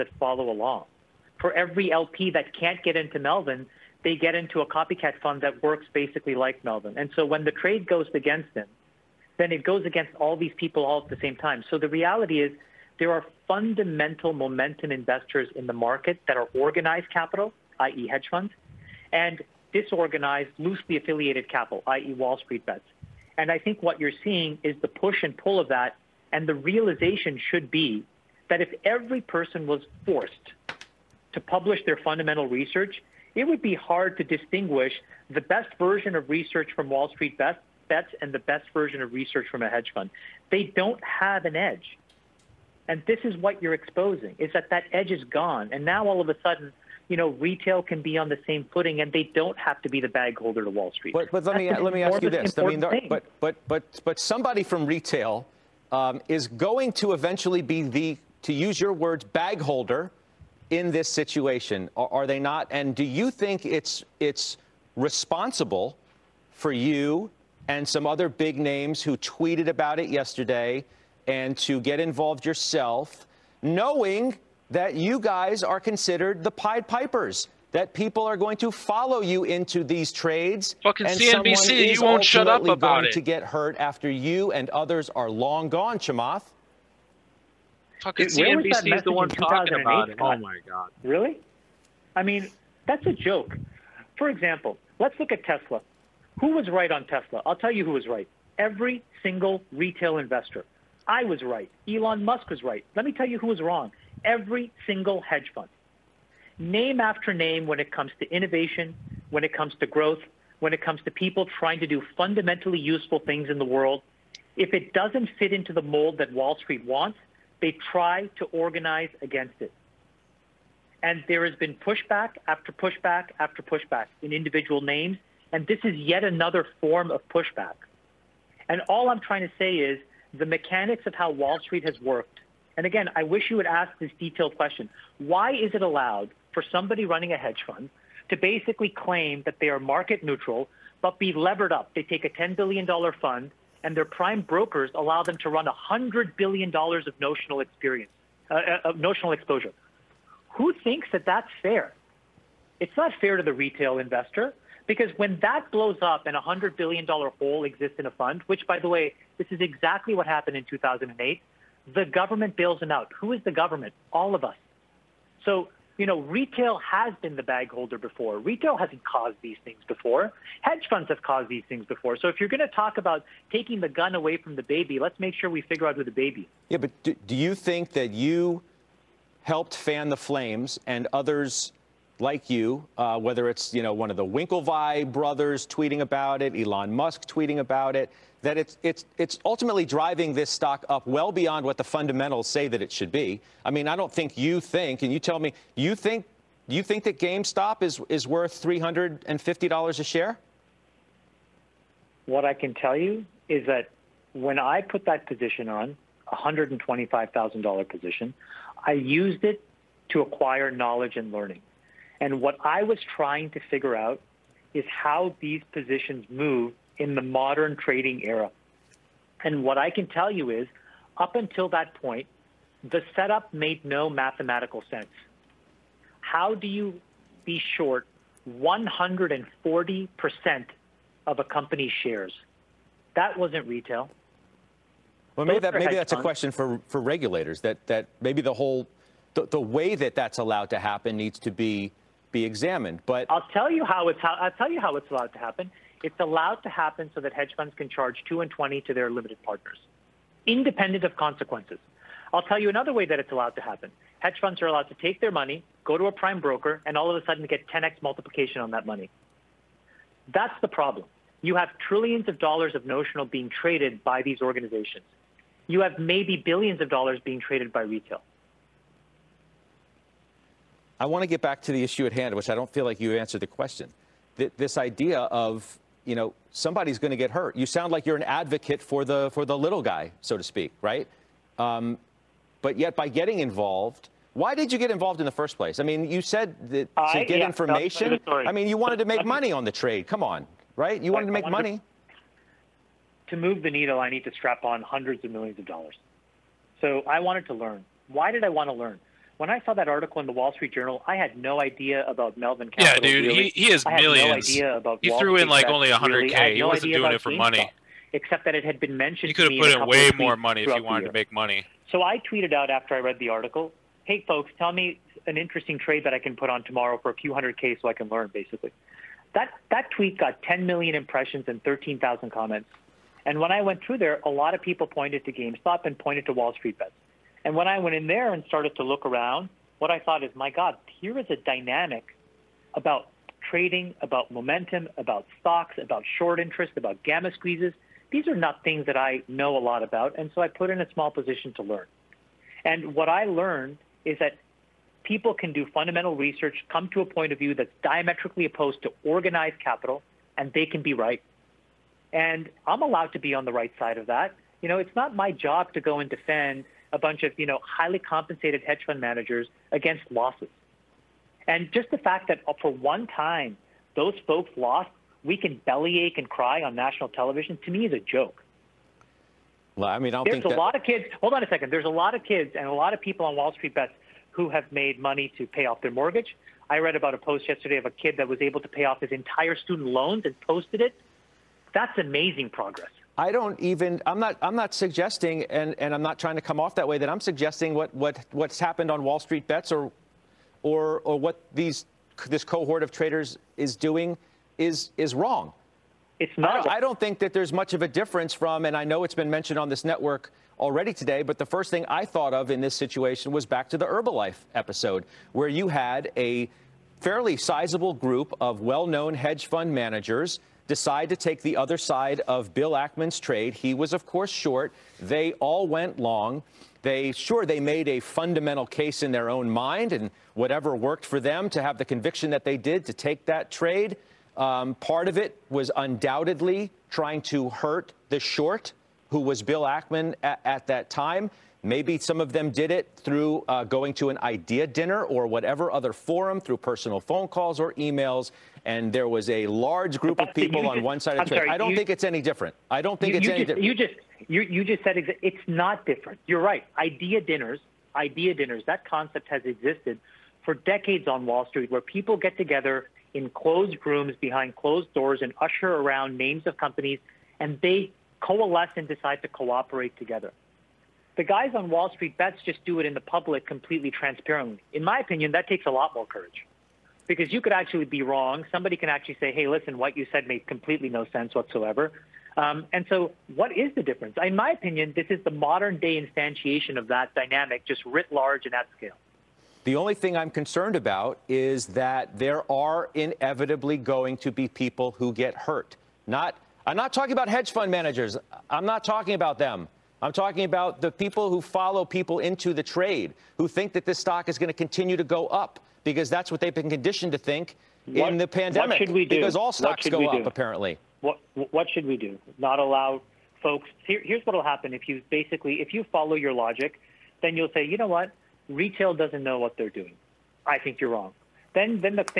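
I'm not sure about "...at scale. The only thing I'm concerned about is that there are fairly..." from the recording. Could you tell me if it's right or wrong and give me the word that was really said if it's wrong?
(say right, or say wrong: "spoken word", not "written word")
wrong: "inevitably", not "fairly".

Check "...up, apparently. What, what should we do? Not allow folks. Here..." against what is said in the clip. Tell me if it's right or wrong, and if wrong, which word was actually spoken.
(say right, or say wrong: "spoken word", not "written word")
right.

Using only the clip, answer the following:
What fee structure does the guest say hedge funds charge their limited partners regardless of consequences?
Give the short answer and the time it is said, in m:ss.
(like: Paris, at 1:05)
Two and twenty, at 4:08.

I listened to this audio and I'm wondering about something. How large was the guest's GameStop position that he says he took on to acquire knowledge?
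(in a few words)
$125,000.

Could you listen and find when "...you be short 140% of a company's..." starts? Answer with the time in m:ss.
3:46.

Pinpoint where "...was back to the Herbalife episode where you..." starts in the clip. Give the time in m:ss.
6:43.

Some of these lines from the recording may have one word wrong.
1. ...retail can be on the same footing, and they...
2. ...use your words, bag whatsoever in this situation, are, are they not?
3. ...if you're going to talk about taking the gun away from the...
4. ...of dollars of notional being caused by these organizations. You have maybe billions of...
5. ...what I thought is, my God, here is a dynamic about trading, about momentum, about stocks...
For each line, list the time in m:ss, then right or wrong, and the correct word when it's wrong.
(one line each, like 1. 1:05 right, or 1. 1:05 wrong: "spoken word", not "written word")
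1. 0:47 right
2. 0:58 wrong: "holder", not "whatsoever"
3. 2:52 right
4. 4:22 wrong: "traded", not "caused"
5. 5:29 right.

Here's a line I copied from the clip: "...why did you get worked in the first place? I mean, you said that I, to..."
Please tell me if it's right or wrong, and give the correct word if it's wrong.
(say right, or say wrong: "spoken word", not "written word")
wrong: "involved", not "worked".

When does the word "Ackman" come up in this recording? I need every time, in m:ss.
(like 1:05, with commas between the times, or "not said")
6:52, 7:09.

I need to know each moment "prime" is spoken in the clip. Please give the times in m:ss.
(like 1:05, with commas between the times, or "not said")
2:24, 4:16.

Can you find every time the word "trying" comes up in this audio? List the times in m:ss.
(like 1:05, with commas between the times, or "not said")
1:51, 2:09, 3:33, 6:26, 7:06.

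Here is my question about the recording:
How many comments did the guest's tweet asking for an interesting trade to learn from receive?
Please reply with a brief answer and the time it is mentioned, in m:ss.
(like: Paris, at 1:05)
13,000, at 5:21.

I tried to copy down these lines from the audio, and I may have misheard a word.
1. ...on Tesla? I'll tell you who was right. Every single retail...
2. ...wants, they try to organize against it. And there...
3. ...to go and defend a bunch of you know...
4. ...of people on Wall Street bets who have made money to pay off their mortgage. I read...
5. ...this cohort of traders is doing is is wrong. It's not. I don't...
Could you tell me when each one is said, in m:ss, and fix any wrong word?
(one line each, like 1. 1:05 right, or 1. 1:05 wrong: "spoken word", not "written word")
1. 1:36 right
2. 1:56 right
3. 5:55 right
4. 6:12 right
5. 6:32 right.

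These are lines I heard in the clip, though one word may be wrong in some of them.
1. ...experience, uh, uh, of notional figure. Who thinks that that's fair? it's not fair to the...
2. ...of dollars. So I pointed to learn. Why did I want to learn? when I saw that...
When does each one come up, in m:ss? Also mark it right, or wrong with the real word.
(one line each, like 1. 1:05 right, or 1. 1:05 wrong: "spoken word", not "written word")
1. 2:27 wrong: "exposure", not "figure"
2. 4:55 wrong: "wanted", not "pointed".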